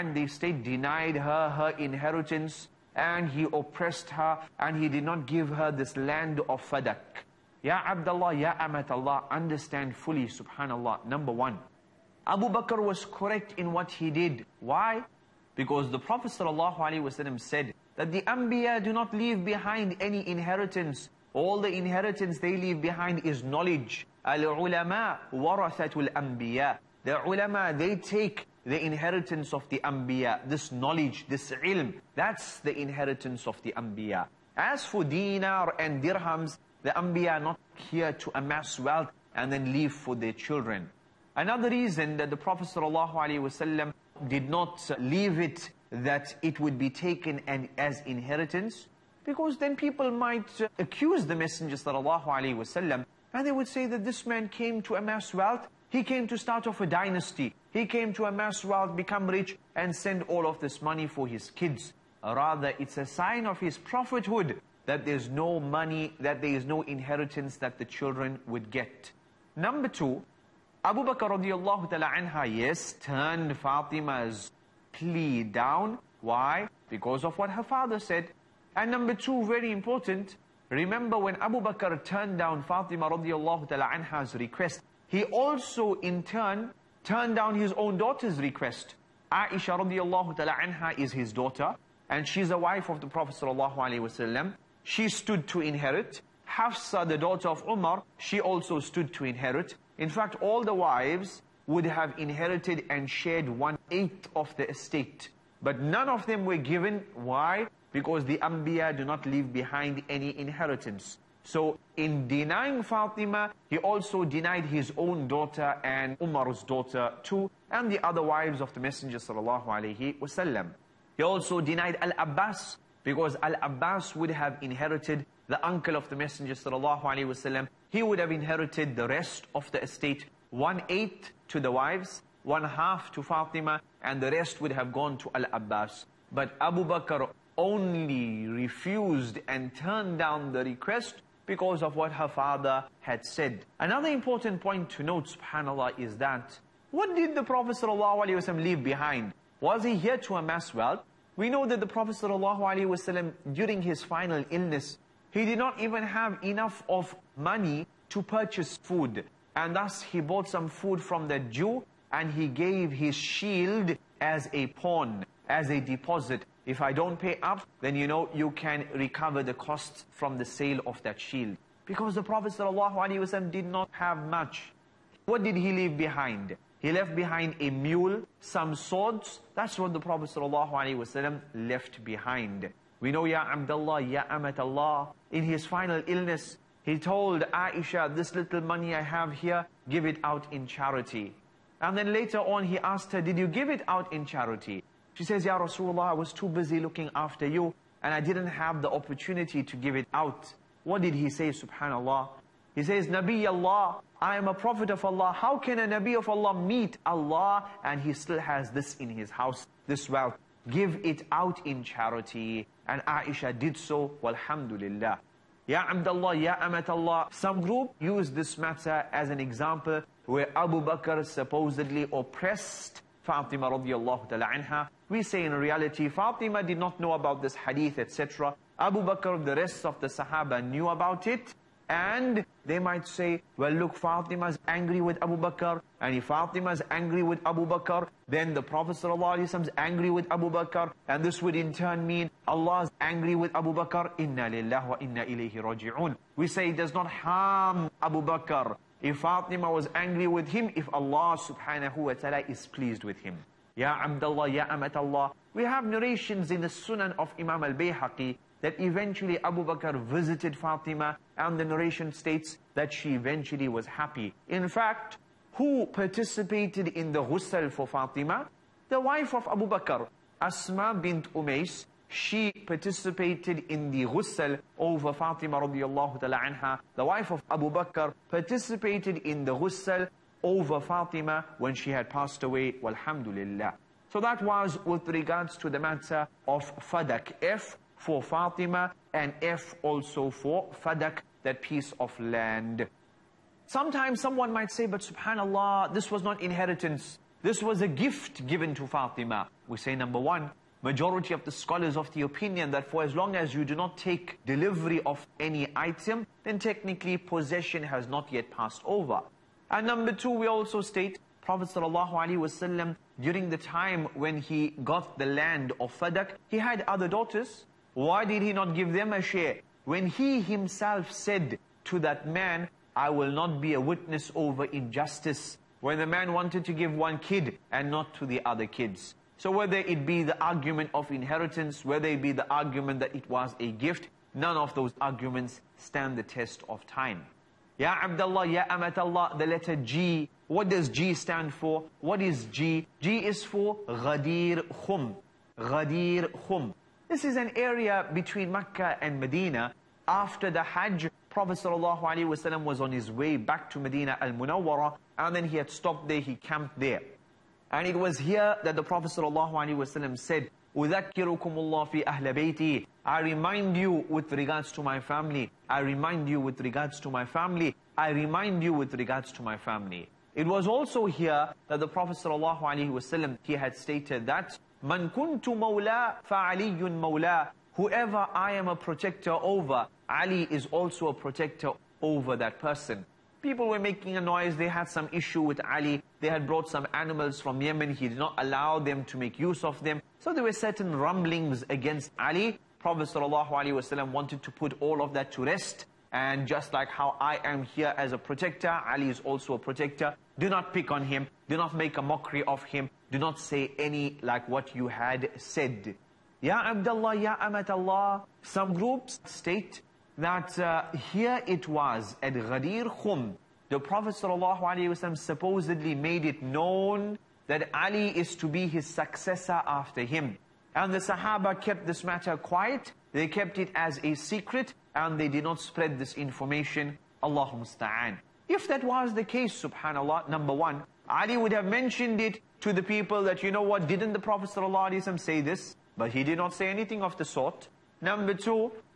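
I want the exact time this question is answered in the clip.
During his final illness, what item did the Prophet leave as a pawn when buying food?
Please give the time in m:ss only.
2:42.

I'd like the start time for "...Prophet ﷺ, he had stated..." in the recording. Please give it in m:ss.
6:11.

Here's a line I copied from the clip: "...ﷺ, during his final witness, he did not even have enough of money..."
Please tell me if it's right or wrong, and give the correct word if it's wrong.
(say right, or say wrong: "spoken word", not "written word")
wrong: "illness", not "witness".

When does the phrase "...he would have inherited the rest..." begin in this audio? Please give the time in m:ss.
2:07.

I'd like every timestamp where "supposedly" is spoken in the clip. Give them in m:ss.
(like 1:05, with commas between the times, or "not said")
3:41, 6:55.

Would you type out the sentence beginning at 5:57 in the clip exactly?
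And it was here that the Prophet ﷺ said, أُذَكِّرُكُمُ اللَّهُ فِي I remind you with regards to my family.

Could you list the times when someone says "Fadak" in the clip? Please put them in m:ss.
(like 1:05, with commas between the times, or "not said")
0:06, 4:46, 4:50, 5:15.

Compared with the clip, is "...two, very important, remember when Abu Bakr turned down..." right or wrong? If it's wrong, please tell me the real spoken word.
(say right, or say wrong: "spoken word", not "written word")
right.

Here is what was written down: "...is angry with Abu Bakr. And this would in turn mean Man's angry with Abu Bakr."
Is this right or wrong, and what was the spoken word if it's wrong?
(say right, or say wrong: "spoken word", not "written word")
wrong: "Allah", not "Man".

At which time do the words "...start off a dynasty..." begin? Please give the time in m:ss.
0:56.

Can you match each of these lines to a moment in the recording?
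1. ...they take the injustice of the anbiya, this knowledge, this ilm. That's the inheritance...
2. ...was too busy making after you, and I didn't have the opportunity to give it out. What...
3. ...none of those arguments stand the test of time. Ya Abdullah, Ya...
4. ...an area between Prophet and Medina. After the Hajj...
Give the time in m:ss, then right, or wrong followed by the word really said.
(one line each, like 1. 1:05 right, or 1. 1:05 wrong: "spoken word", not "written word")
1. 0:27 wrong: "inheritance", not "injustice"
2. 3:16 wrong: "looking", not "making"
3. 5:34 right
4. 5:47 wrong: "Mecca", not "Prophet".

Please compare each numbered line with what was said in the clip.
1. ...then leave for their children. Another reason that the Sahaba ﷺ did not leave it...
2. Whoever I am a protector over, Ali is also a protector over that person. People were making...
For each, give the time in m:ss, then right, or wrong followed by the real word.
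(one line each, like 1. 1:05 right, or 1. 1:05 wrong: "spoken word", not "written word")
1. 0:39 wrong: "Prophet", not "Sahaba"
2. 6:17 right.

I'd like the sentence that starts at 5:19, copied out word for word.
When he himself said to that man, I will not be a witness over injustice.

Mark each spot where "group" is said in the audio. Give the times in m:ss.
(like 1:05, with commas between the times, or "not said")
3:37, 6:48.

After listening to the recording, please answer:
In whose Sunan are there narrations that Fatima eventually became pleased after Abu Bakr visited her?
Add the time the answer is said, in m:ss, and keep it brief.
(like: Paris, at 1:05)
Imam al-Bayhaqi, at 4:17.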